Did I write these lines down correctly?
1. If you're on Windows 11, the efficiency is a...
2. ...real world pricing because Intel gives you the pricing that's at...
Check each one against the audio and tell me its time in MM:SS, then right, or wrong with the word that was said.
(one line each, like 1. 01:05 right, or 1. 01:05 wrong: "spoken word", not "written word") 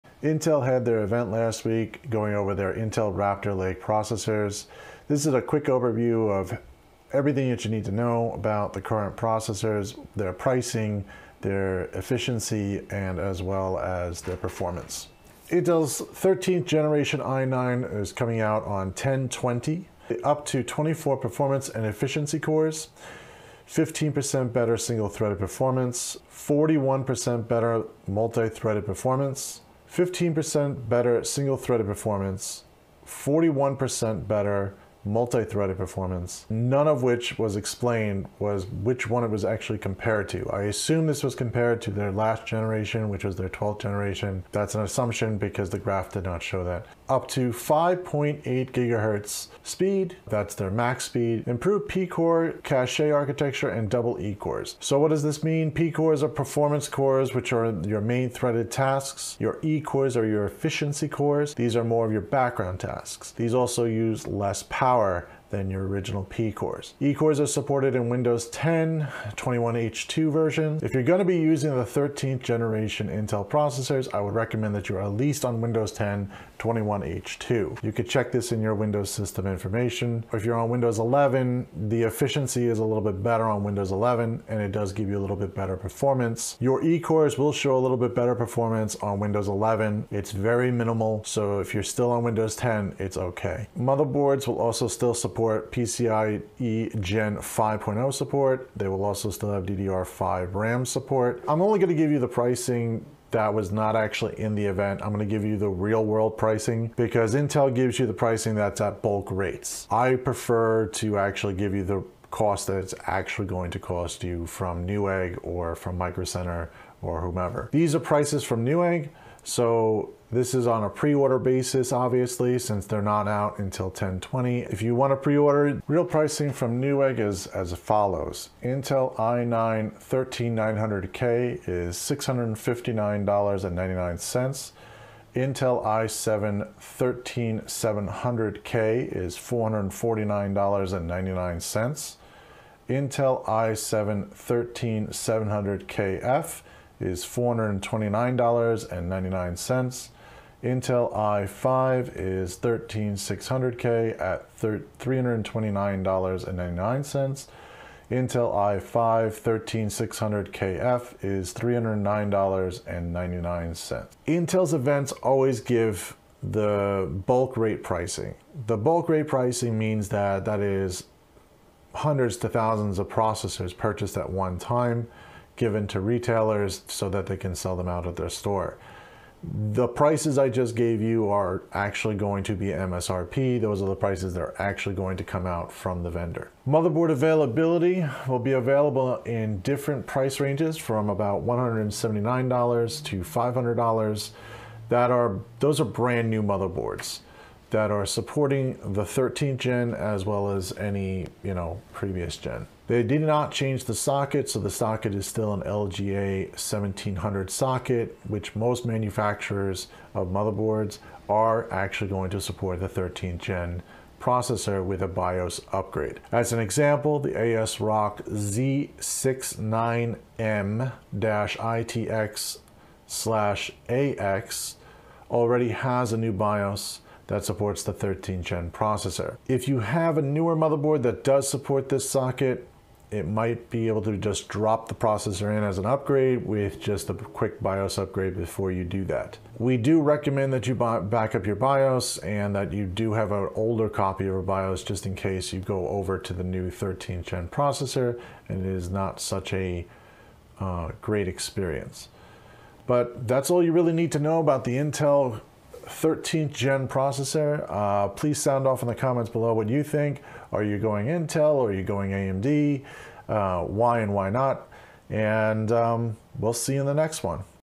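1. 01:20 right
2. 01:45 right.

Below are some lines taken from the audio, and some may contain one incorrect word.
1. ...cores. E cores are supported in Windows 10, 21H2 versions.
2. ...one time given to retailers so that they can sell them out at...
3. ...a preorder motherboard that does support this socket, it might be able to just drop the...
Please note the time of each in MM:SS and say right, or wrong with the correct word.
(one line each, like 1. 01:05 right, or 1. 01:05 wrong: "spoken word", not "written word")
1. 01:06 right
2. 02:54 right
3. 03:50 wrong: "newer", not "preorder".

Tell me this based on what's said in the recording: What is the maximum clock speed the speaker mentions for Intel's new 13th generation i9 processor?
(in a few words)
5.8 gigahertz.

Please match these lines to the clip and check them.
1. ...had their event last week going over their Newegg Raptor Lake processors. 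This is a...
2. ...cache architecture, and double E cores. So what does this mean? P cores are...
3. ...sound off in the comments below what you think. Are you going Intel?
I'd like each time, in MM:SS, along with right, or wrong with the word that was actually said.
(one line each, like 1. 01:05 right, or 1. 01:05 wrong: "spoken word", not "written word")
1. 00:00 wrong: "Intel", not "Newegg"
2. 00:52 right
3. 04:18 right.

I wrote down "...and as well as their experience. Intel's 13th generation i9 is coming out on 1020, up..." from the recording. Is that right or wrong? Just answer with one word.
wrong.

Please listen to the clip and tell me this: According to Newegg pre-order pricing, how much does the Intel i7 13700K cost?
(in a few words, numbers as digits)
$449.99.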